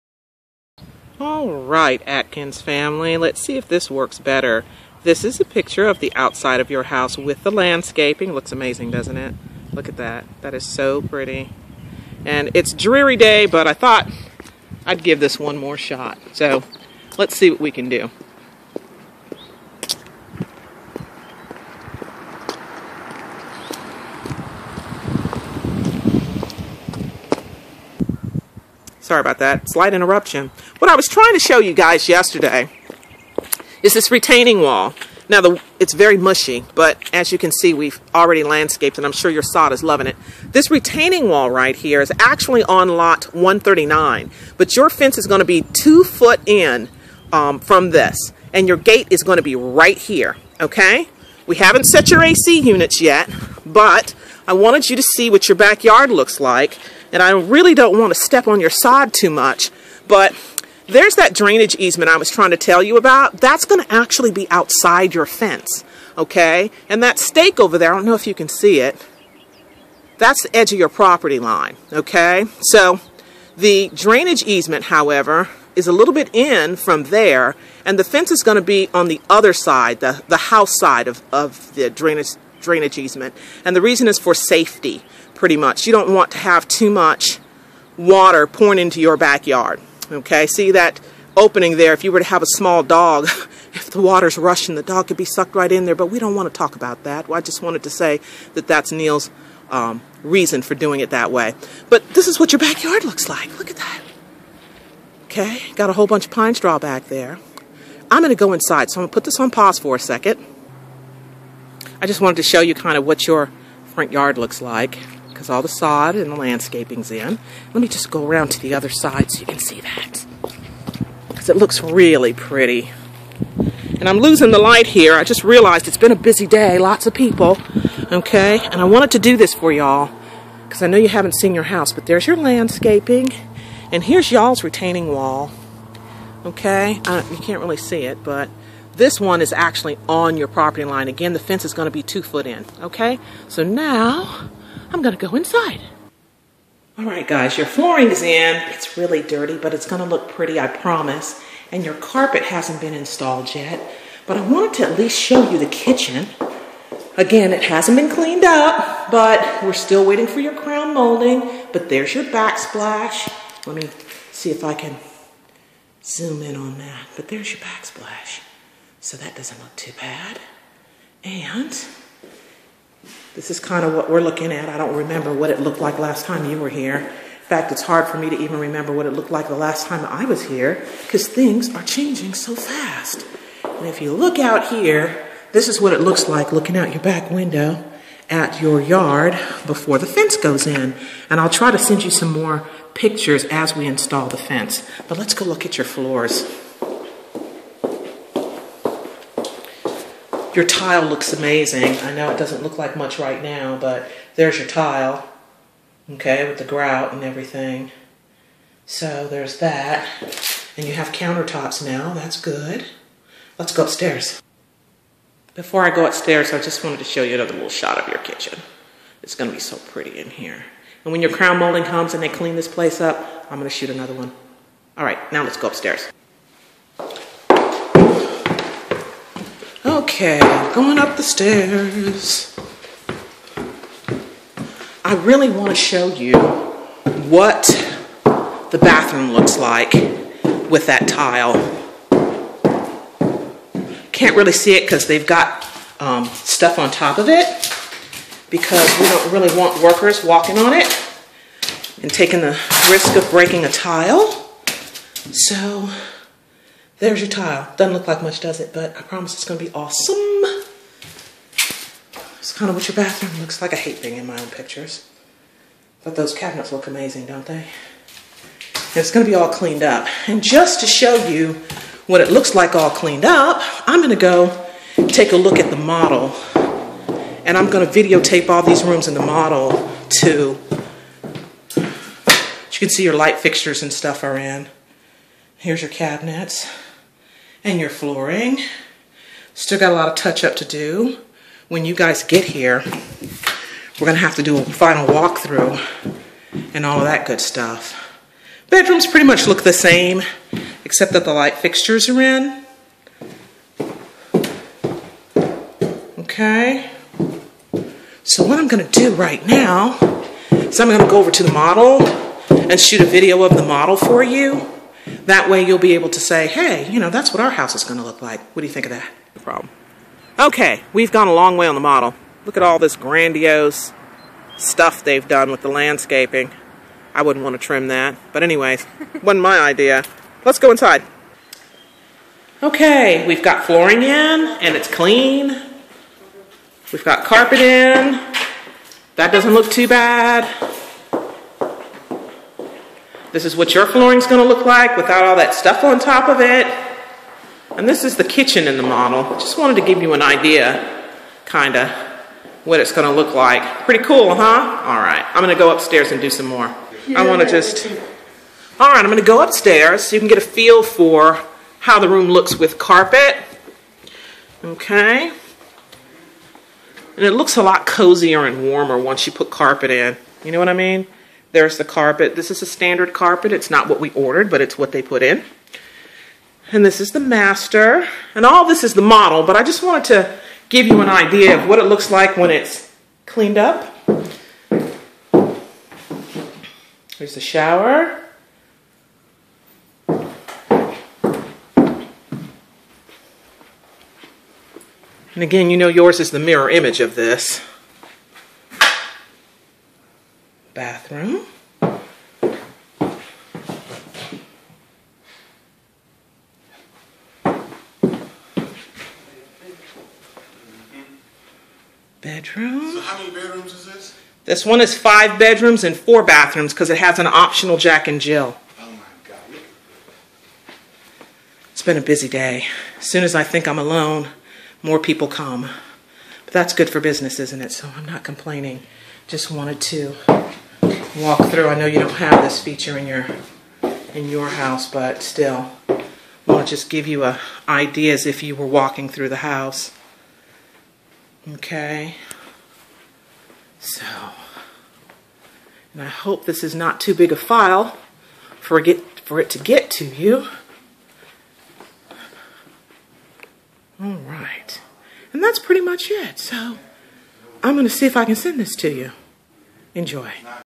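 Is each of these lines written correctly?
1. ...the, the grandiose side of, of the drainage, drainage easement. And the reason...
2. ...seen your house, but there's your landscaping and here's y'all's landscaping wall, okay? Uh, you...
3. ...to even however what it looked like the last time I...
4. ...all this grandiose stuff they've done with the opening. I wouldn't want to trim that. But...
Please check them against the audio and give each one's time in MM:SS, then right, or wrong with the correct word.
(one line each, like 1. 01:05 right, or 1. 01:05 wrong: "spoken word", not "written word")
1. 01:19 wrong: "house", not "grandiose"
2. 02:11 wrong: "retaining", not "landscaping"
3. 02:58 wrong: "remember", not "however"
4. 05:22 wrong: "landscaping", not "opening".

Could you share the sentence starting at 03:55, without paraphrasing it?
I really want to show you what the bathroom looks like with that tile.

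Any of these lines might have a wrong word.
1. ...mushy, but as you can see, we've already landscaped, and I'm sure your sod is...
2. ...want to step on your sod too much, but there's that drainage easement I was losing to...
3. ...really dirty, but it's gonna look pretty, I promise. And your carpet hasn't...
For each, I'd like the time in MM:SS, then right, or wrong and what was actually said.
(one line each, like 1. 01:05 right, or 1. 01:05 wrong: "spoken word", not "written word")
1. 00:36 right
2. 00:57 wrong: "trying", not "losing"
3. 02:28 right.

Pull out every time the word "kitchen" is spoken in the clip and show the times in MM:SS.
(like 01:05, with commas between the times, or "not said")
02:35, 03:38, 05:48.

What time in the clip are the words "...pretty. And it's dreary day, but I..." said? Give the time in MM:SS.
00:10.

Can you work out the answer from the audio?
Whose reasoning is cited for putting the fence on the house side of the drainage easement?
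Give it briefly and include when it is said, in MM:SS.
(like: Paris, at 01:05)
Neil, at 01:38.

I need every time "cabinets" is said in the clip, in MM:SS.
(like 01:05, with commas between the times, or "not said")
04:26, 04:45.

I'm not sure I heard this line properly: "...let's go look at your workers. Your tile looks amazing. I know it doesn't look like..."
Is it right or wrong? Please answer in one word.
wrong.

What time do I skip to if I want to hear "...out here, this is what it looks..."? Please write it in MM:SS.
03:04.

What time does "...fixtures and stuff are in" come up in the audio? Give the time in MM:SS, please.
04:43.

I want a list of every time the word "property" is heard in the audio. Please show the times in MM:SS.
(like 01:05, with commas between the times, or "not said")
01:10, 02:20.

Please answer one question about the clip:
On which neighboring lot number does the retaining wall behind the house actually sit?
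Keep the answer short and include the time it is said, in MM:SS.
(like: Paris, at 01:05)
139, at 00:42.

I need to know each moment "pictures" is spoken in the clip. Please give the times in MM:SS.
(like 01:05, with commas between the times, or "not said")
00:05, 03:12, 04:24.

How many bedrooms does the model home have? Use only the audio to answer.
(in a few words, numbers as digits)
5.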